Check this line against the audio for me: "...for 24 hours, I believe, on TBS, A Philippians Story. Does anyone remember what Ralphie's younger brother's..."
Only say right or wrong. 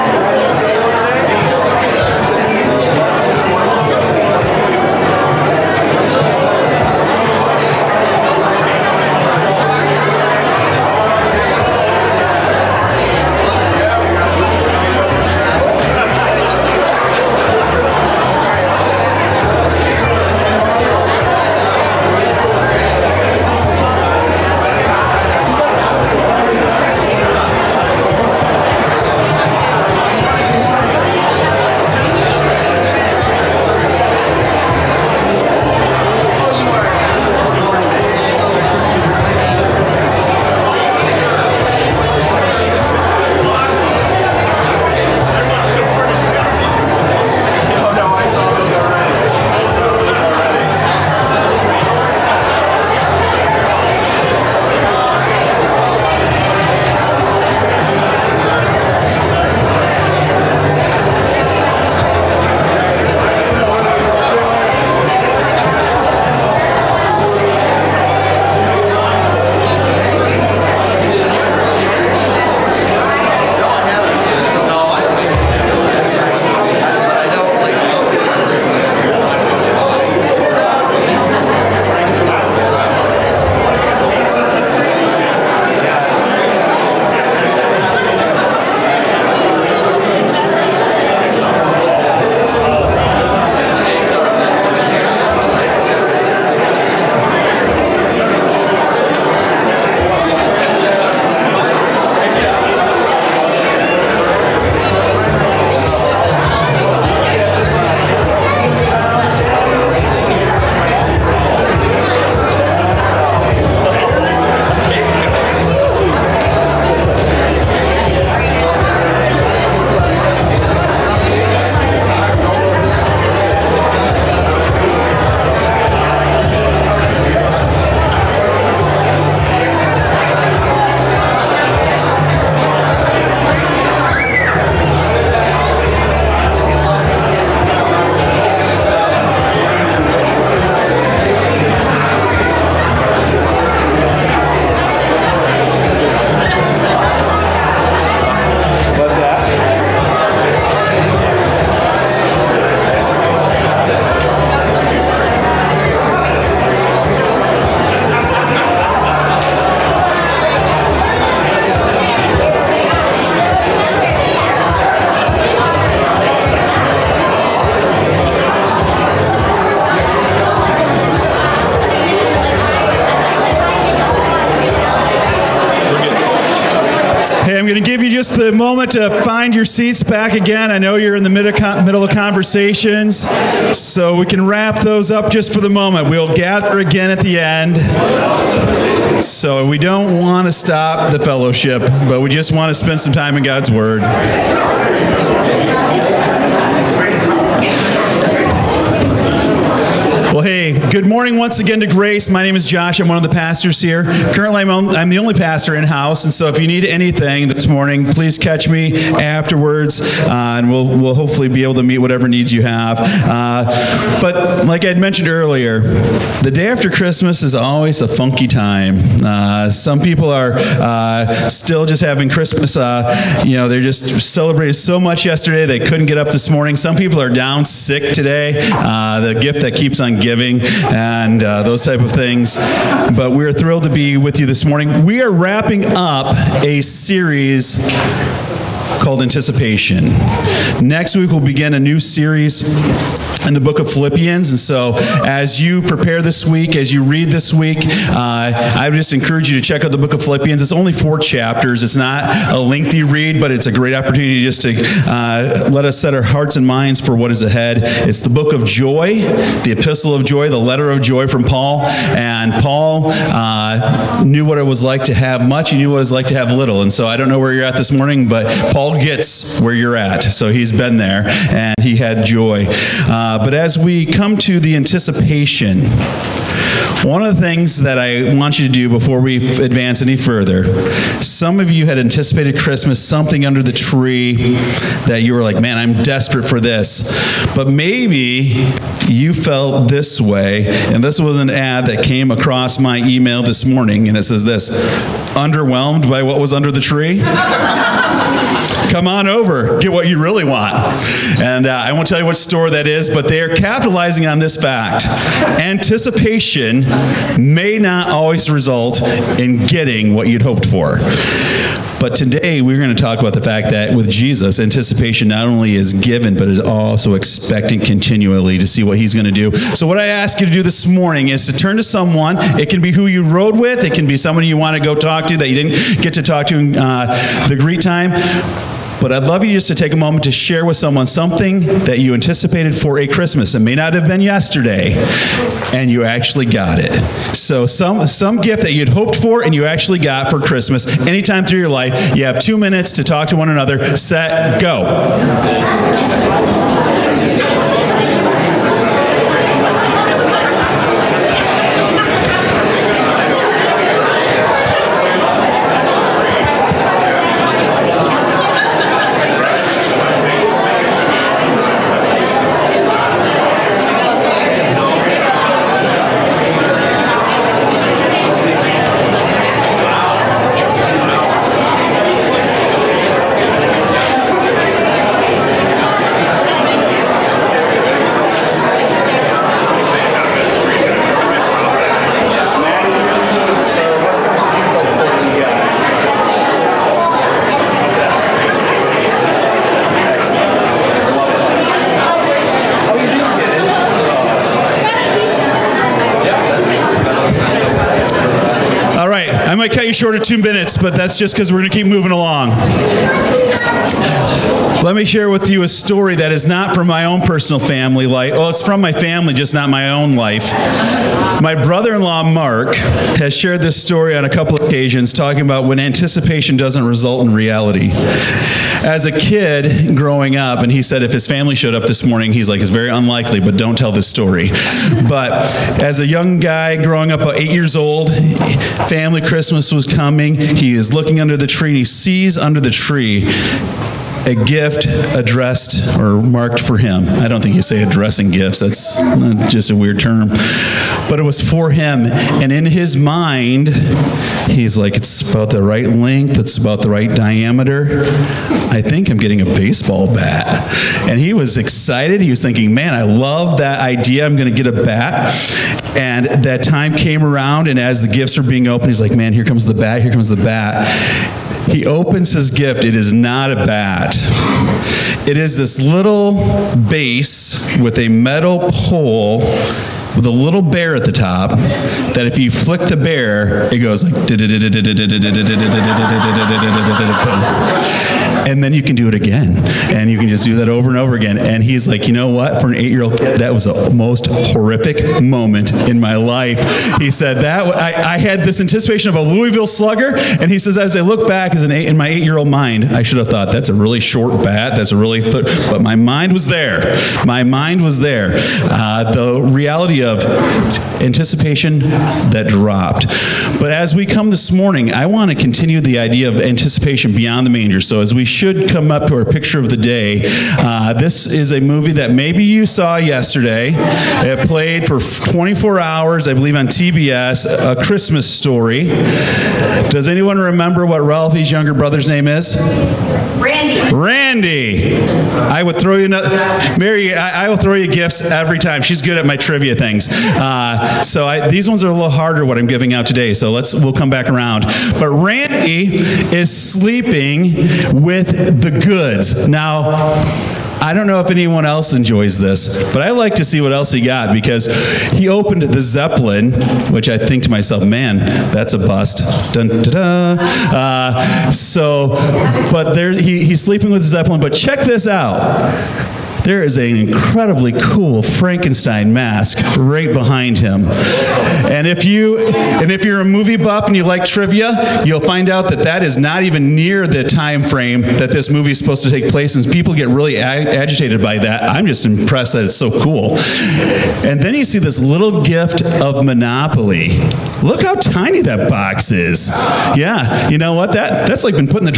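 wrong.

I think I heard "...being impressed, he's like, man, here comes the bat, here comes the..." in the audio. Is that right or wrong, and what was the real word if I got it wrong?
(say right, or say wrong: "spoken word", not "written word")
wrong: "opened", not "impressed".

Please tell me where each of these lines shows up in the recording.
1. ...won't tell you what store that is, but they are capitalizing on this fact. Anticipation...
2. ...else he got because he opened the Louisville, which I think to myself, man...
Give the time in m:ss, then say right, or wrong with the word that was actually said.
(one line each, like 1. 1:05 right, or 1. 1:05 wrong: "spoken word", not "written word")
1. 5:01 right
2. 9:03 wrong: "Zeppelin", not "Louisville".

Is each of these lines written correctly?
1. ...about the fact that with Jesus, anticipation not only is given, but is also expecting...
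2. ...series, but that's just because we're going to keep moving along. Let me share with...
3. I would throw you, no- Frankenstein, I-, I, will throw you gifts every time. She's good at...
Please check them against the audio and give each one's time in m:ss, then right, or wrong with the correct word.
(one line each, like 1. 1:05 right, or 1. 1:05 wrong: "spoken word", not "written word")
1. 5:13 right
2. 6:40 wrong: "minutes", not "series"
3. 8:44 wrong: "Mary", not "Frankenstein".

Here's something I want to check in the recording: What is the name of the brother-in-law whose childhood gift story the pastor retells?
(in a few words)
Mark.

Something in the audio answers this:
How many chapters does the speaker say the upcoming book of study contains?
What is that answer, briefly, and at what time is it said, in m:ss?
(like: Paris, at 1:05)
4, at 4:10.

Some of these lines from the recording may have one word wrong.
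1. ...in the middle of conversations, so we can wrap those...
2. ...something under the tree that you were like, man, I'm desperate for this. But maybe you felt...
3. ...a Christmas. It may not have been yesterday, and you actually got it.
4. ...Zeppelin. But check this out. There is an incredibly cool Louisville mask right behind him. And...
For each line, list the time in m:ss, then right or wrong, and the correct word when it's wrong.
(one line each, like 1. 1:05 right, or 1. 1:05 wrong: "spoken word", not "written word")
1. 3:01 right
2. 4:43 right
3. 5:32 right
4. 9:14 wrong: "Frankenstein", not "Louisville".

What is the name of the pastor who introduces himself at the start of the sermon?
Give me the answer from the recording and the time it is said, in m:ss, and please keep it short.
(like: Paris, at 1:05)
Josh, at 3:22.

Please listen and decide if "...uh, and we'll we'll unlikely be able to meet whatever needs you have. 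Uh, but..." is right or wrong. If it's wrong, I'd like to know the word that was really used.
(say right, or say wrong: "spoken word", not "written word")
wrong: "hopefully", not "unlikely".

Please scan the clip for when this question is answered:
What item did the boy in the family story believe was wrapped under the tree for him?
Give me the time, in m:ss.
7:29.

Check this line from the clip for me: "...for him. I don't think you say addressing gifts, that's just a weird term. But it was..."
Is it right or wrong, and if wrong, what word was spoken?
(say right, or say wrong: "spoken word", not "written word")
right.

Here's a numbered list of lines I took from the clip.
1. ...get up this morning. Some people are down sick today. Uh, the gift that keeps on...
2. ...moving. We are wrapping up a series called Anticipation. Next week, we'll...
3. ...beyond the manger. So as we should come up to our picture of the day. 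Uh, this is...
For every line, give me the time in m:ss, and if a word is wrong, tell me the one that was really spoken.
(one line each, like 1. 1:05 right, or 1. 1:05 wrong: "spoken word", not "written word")
1. 3:46 right
2. 3:54 wrong: "morning", not "moving"
3. 8:27 right.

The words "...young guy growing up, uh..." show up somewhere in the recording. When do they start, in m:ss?
7:06.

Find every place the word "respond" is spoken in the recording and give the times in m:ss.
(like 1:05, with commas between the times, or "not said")
not said.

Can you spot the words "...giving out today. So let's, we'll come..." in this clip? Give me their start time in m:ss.
8:52.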